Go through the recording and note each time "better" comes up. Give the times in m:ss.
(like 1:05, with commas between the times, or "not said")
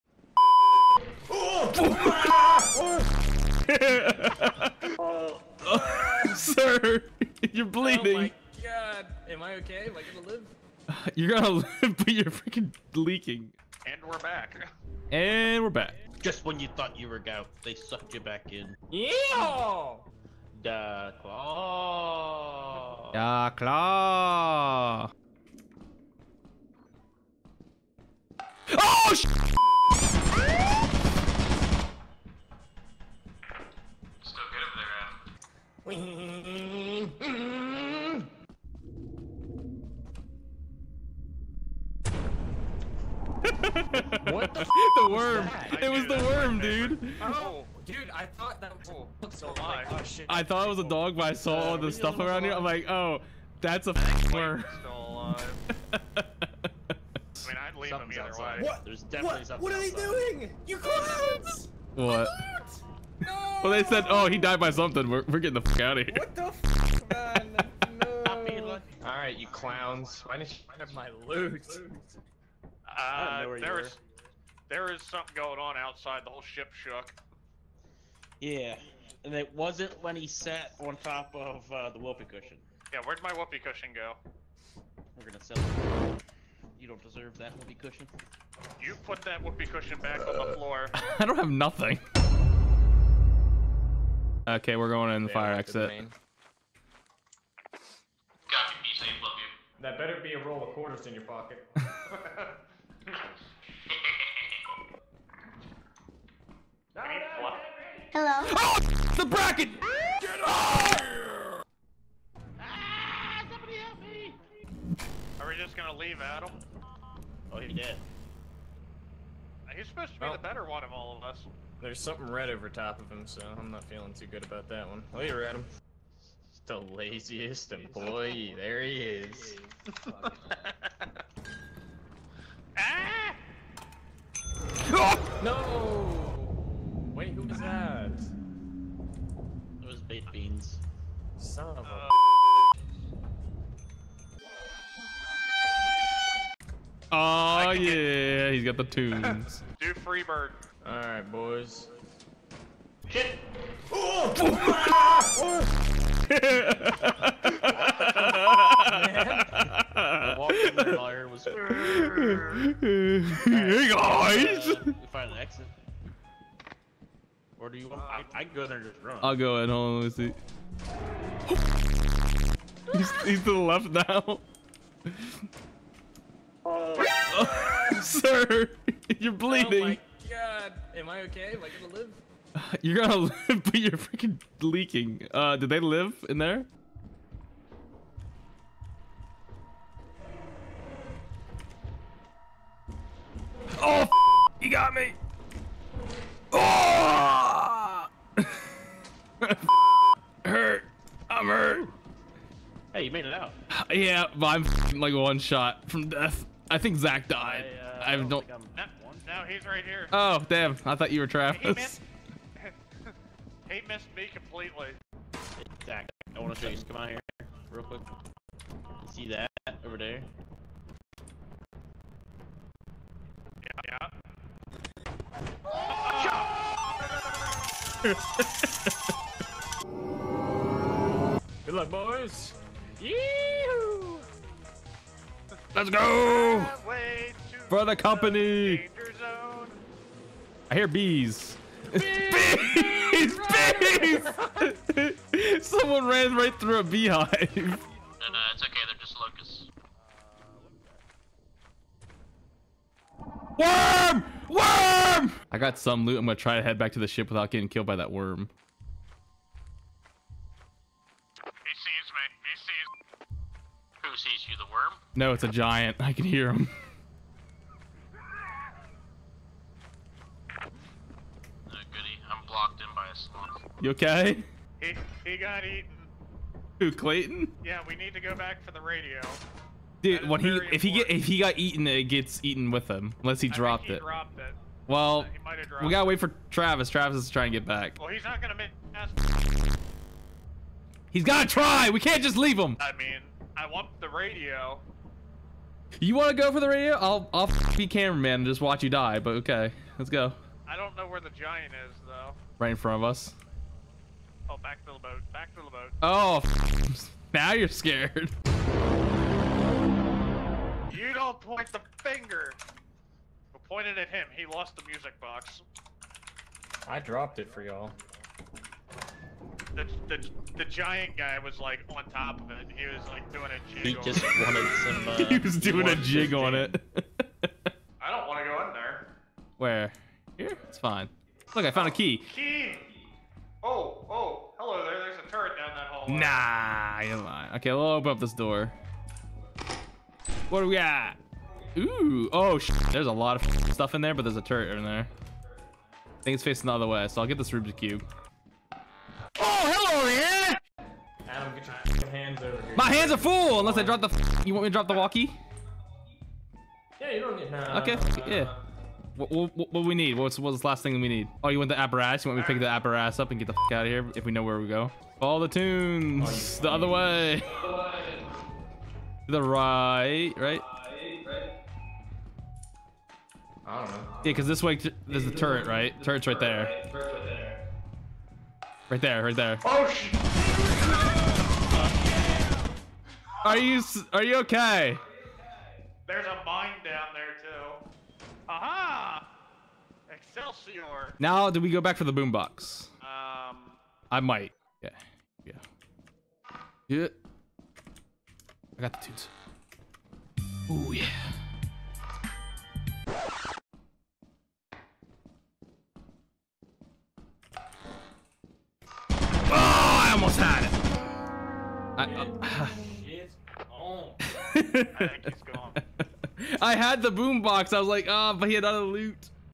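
1:39, 2:00.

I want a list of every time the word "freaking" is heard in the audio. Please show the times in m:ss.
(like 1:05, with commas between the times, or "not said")
0:12, 3:03.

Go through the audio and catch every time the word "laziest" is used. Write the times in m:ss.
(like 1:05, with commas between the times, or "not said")
2:06.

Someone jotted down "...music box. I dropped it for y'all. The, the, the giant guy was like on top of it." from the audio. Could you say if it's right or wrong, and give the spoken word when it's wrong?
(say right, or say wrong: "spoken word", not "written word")
right.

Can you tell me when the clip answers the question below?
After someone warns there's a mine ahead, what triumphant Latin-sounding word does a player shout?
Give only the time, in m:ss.
6:30.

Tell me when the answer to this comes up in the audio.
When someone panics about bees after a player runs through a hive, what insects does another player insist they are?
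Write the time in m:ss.
4:09.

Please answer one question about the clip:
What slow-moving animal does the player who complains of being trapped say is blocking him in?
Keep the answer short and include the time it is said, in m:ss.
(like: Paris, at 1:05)
a sloth, at 4:33.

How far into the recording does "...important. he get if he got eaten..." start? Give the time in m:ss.
4:40.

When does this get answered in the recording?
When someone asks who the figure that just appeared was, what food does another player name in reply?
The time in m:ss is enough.
2:20.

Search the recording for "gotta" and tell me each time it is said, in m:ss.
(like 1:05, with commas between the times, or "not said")
4:45, 4:51.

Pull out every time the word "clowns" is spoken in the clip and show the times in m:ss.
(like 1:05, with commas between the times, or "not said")
1:00, 1:09.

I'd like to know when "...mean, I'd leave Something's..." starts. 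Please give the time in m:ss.
0:57.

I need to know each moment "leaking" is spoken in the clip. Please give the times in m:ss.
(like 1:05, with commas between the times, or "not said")
0:12, 3:04.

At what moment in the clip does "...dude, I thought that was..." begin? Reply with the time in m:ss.
0:47.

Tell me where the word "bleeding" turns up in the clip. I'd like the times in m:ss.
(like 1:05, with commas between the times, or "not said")
0:07, 2:59.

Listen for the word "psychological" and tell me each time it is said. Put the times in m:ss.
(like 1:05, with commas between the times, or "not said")
not said.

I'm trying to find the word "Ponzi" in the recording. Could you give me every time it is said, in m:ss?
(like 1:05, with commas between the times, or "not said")
not said.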